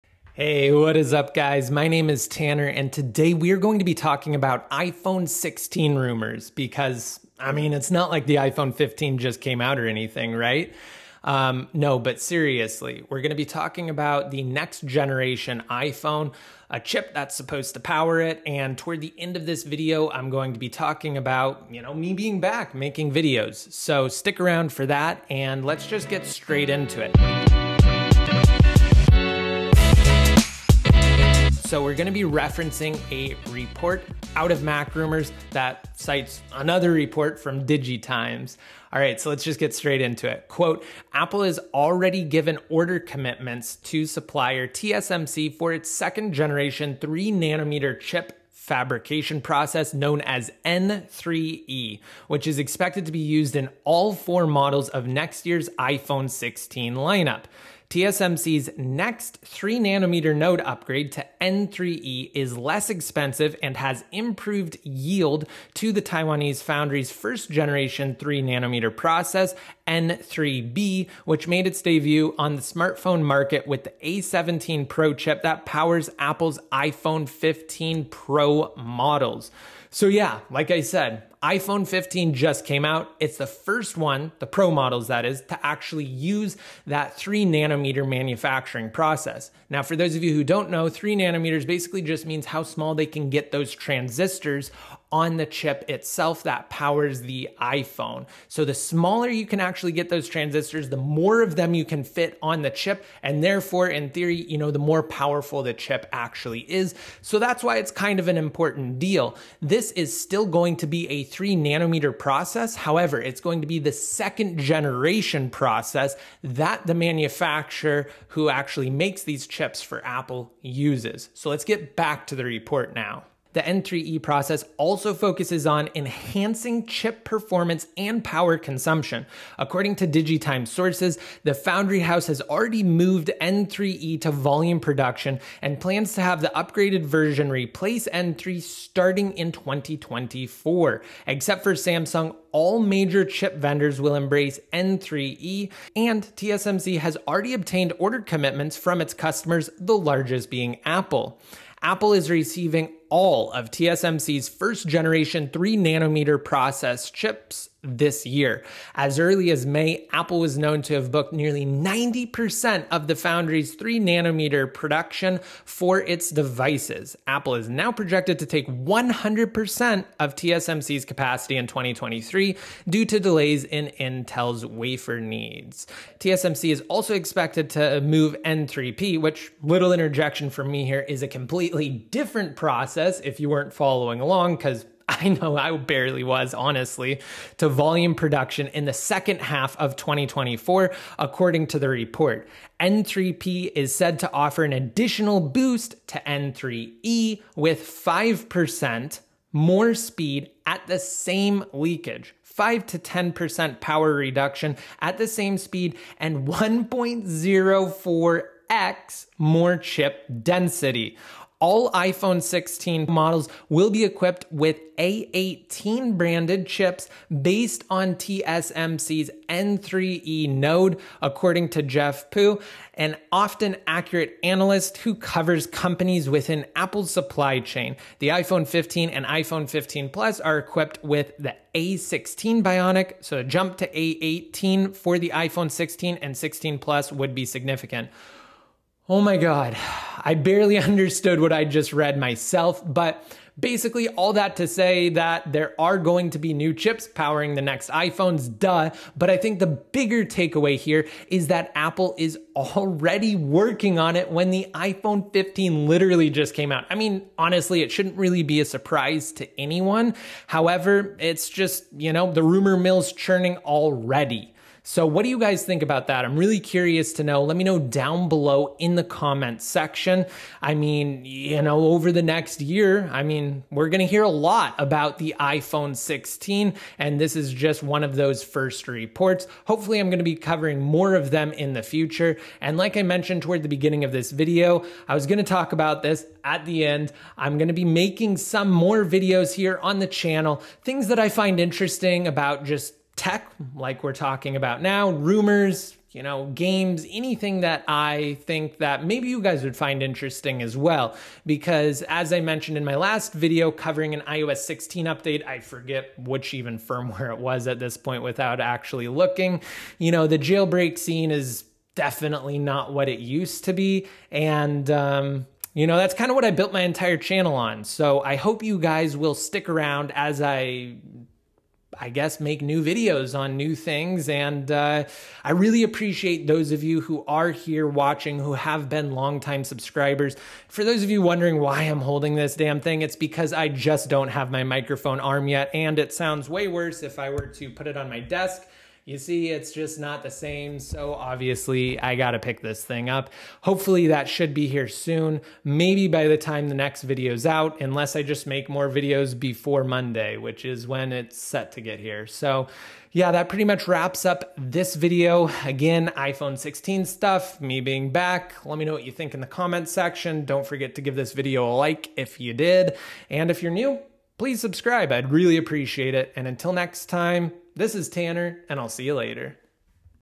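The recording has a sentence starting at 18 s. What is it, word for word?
And toward the end of this video, I'm going to be talking about, you know, me being back making videos.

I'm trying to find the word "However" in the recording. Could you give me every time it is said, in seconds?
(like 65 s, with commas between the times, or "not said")
112 s, 260 s.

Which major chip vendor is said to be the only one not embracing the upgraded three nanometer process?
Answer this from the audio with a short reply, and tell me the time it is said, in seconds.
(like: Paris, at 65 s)
Samsung, at 141 s.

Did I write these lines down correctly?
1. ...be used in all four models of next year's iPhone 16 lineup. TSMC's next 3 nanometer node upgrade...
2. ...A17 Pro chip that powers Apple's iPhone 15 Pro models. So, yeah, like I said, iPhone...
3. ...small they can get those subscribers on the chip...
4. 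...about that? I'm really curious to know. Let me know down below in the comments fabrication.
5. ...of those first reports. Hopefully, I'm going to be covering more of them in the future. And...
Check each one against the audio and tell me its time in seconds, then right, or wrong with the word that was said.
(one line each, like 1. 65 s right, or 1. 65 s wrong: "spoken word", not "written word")
1. 53 s right
2. 74 s right
3. 92 s wrong: "transistors", not "subscribers"
4. 265 s wrong: "section", not "fabrication"
5. 278 s right.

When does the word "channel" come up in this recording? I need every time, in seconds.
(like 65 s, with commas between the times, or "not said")
290 s, 317 s.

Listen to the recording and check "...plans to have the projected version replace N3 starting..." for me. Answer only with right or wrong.
wrong.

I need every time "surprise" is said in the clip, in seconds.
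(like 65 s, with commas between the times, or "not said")
258 s.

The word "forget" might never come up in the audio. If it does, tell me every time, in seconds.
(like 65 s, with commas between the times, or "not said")
305 s, 360 s.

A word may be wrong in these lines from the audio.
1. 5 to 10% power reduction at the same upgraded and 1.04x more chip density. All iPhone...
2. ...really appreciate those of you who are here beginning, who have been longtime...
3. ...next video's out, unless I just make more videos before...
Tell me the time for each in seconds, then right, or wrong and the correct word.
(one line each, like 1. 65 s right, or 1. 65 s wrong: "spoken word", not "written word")
1. 202 s wrong: "speed", not "upgraded"
2. 325 s wrong: "watching", not "beginning"
3. 346 s right.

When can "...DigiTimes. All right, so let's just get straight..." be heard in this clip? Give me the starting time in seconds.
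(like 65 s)
37 s.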